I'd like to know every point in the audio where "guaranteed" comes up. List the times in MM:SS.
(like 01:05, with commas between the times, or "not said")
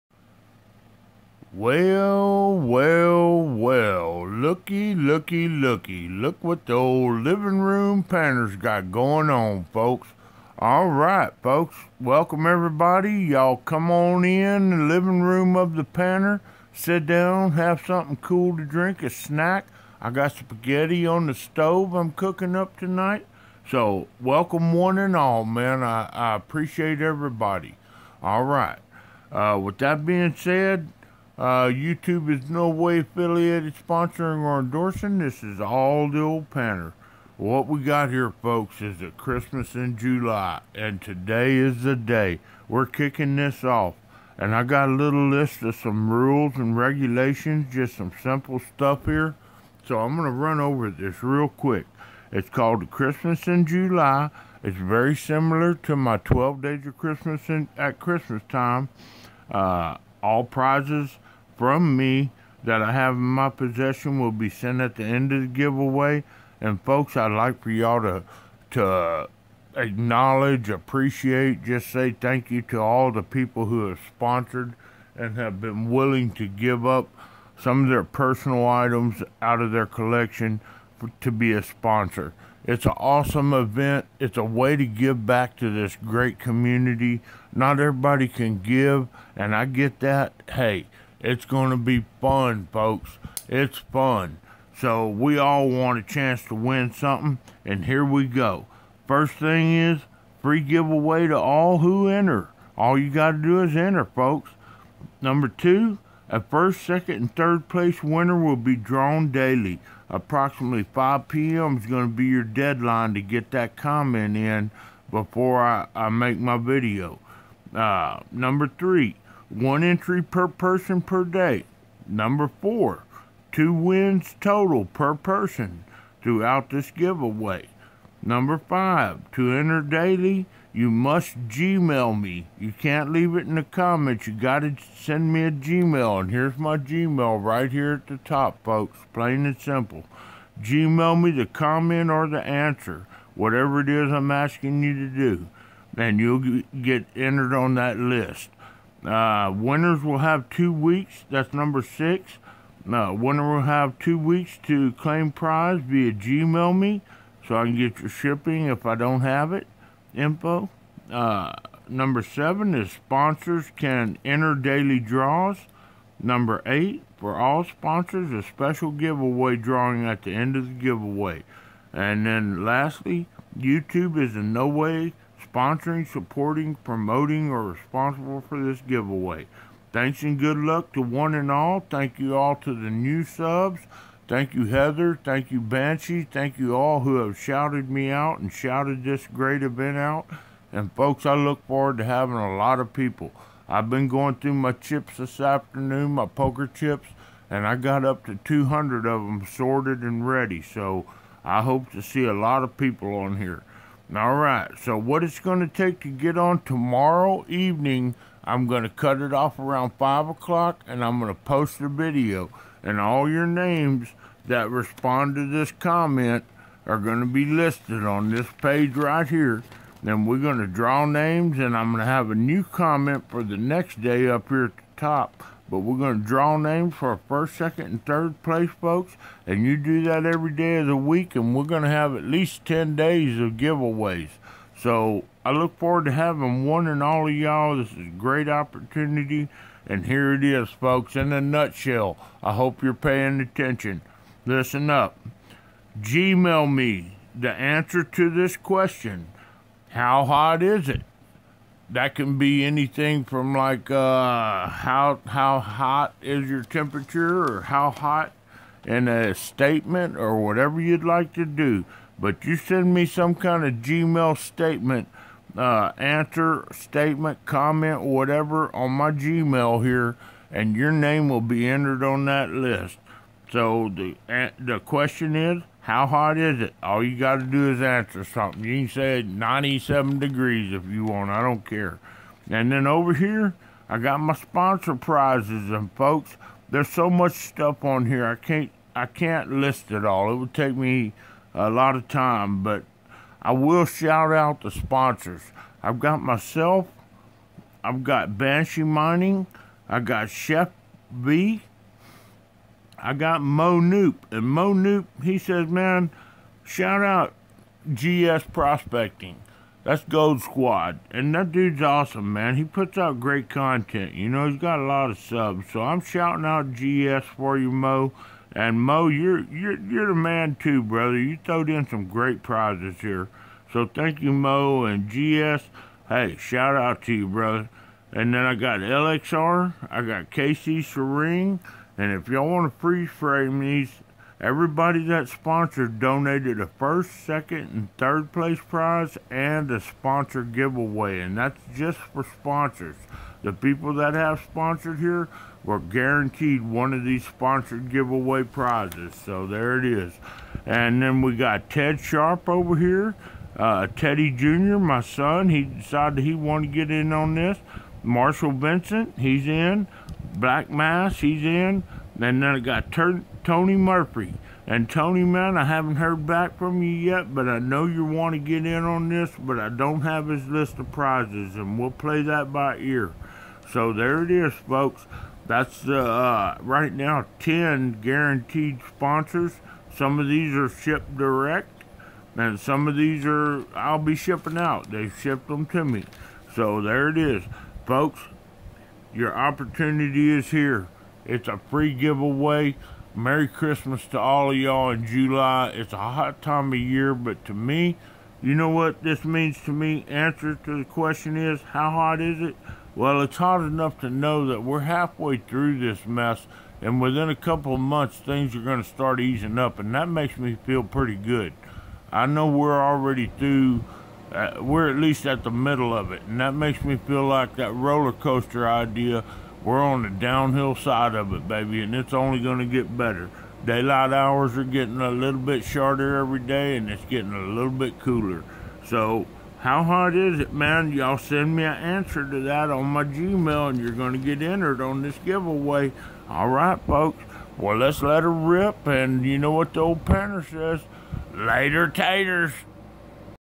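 05:45, 06:18.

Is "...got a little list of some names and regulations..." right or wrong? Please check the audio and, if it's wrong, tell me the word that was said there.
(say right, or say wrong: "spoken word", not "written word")
wrong: "rules", not "names".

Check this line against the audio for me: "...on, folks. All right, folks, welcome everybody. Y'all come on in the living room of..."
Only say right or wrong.
right.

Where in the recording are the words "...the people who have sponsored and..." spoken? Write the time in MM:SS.
01:13.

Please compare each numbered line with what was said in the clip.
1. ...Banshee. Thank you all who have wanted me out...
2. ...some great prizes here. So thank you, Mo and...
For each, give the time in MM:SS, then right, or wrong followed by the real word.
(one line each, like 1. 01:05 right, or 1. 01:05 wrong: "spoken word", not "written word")
1. 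03:05 wrong: "shouted", not "wanted"
2. 05:21 right.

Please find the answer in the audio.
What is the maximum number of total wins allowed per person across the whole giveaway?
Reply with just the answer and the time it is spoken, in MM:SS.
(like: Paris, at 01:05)
2, at 02:03.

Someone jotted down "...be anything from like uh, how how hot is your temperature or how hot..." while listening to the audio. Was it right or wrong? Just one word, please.
right.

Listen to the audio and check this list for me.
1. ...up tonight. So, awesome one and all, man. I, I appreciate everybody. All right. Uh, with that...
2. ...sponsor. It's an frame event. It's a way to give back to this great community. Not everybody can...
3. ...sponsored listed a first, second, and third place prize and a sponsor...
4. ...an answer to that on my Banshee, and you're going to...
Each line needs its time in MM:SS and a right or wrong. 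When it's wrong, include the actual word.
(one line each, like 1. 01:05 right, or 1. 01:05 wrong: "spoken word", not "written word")
1. 00:22 wrong: "welcome", not "awesome"
2. 01:21 wrong: "awesome", not "frame"
3. 05:35 wrong: "donated", not "listed"
4. 07:11 wrong: "Gmail", not "Banshee".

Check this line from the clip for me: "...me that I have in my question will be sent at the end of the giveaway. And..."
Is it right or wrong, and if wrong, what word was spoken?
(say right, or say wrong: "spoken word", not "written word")
wrong: "possession", not "question".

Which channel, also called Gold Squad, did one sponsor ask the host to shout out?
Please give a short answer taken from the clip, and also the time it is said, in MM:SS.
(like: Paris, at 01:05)
GS Prospecting, at 05:07.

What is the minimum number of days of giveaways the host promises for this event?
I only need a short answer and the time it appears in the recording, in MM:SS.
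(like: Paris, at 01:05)
10, at 03:52.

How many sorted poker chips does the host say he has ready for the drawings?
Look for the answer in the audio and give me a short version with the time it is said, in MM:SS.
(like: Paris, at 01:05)
200, at 03:18.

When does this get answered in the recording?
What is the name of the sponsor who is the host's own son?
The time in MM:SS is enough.
05:53.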